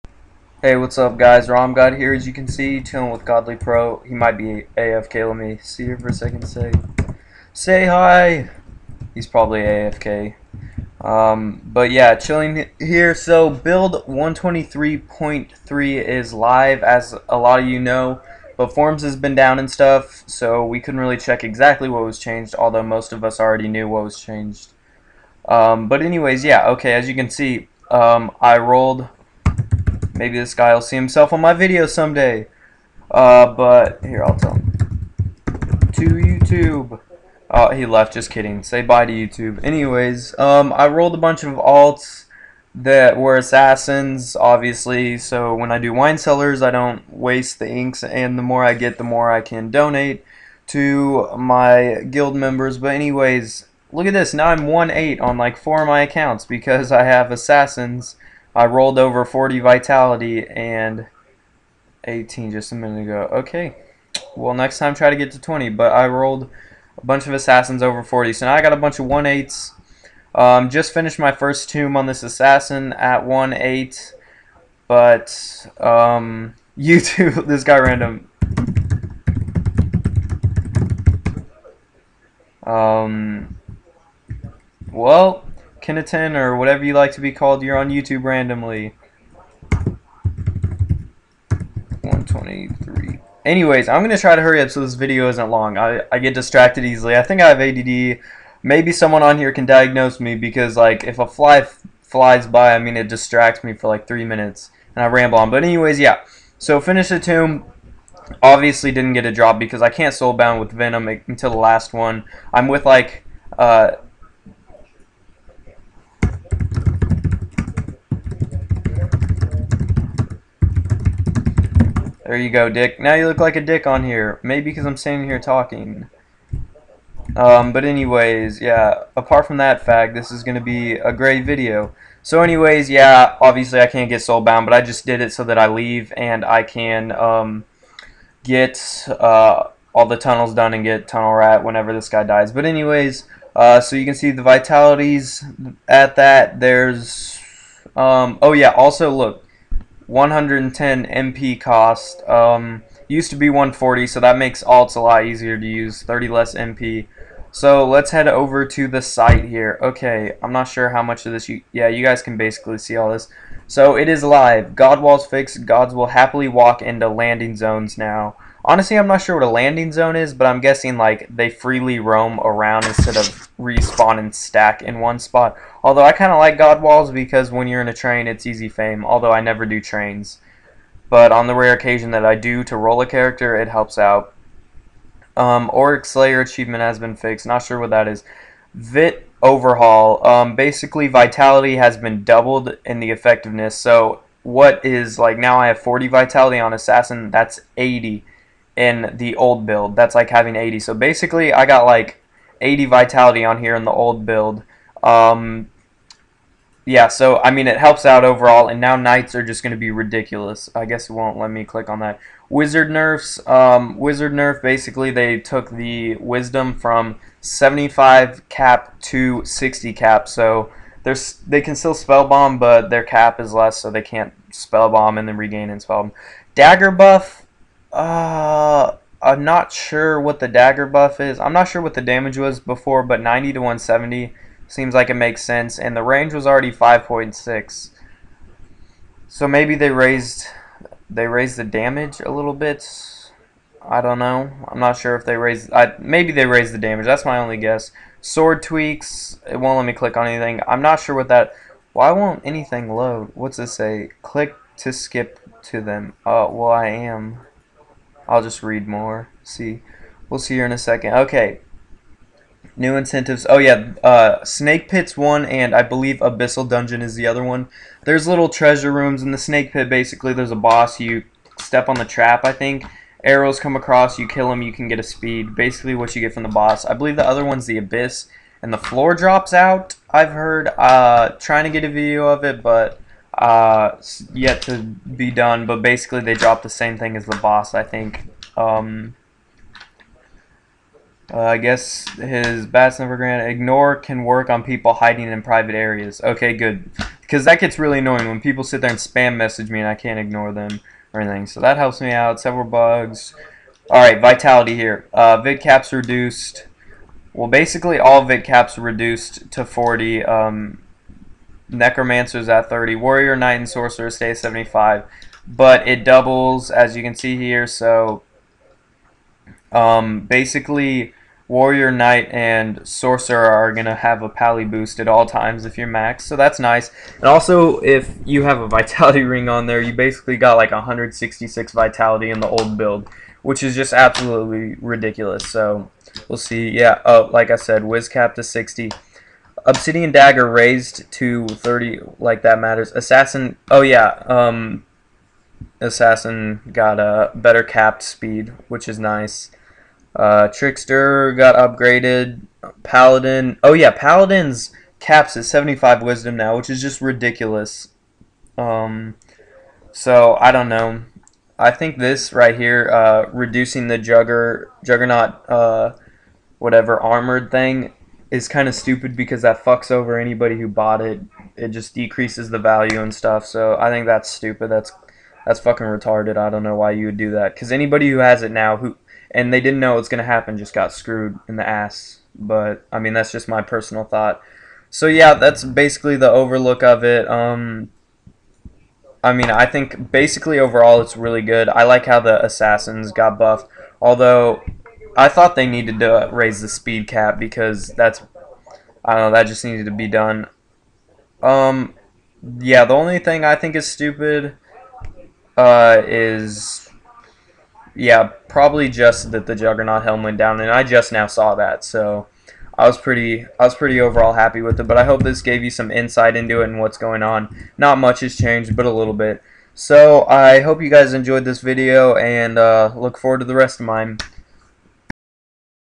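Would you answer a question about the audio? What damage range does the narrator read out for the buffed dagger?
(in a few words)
90 to 170.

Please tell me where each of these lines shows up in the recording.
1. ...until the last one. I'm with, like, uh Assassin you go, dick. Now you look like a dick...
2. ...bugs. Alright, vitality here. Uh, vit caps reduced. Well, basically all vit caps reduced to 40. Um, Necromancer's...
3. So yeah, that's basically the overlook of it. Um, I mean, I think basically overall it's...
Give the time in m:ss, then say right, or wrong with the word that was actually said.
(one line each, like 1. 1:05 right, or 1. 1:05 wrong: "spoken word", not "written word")
1. 1:51 wrong: "There", not "Assassin"
2. 5:02 right
3. 6:24 right.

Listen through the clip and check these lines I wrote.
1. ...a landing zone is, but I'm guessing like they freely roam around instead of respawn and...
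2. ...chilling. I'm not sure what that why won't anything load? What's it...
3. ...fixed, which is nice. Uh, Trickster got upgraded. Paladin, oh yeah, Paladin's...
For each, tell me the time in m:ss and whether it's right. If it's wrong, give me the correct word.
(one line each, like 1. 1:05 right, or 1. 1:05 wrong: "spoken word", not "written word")
1. 2:49 right
2. 4:10 wrong: "anything", not "chilling"
3. 5:48 wrong: "speed", not "fixed".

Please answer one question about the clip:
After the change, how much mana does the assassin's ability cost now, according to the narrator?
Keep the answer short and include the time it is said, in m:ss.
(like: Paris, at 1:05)
110, at 2:30.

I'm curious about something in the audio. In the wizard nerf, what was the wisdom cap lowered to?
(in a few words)
60.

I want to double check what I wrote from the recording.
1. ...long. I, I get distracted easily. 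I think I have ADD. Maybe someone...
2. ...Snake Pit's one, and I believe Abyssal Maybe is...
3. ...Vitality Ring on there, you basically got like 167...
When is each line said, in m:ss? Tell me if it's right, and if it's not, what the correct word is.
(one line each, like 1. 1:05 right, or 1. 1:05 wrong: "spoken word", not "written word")
1. 1:35 right
2. 4:24 wrong: "Dungeon", not "Maybe"
3. 5:28 wrong: "166", not "167".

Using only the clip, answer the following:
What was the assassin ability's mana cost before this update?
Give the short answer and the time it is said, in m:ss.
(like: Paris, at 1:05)
140, at 2:33.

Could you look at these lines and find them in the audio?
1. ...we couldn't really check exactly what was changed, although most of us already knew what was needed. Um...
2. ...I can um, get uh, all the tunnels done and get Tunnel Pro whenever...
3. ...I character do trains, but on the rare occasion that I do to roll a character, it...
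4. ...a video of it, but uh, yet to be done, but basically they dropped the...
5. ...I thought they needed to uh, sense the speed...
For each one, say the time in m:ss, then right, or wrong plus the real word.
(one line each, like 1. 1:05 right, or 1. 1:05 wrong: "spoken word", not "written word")
1. 0:20 wrong: "changed", not "needed"
2. 2:16 wrong: "Rat", not "Pro"
3. 2:59 wrong: "never", not "character"
4. 4:41 right
5. 6:35 wrong: "raise", not "sense".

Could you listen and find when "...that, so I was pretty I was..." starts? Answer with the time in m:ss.
6:51.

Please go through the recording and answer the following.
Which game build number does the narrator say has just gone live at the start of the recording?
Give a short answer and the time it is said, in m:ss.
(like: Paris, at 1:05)
123.3, at 0:14.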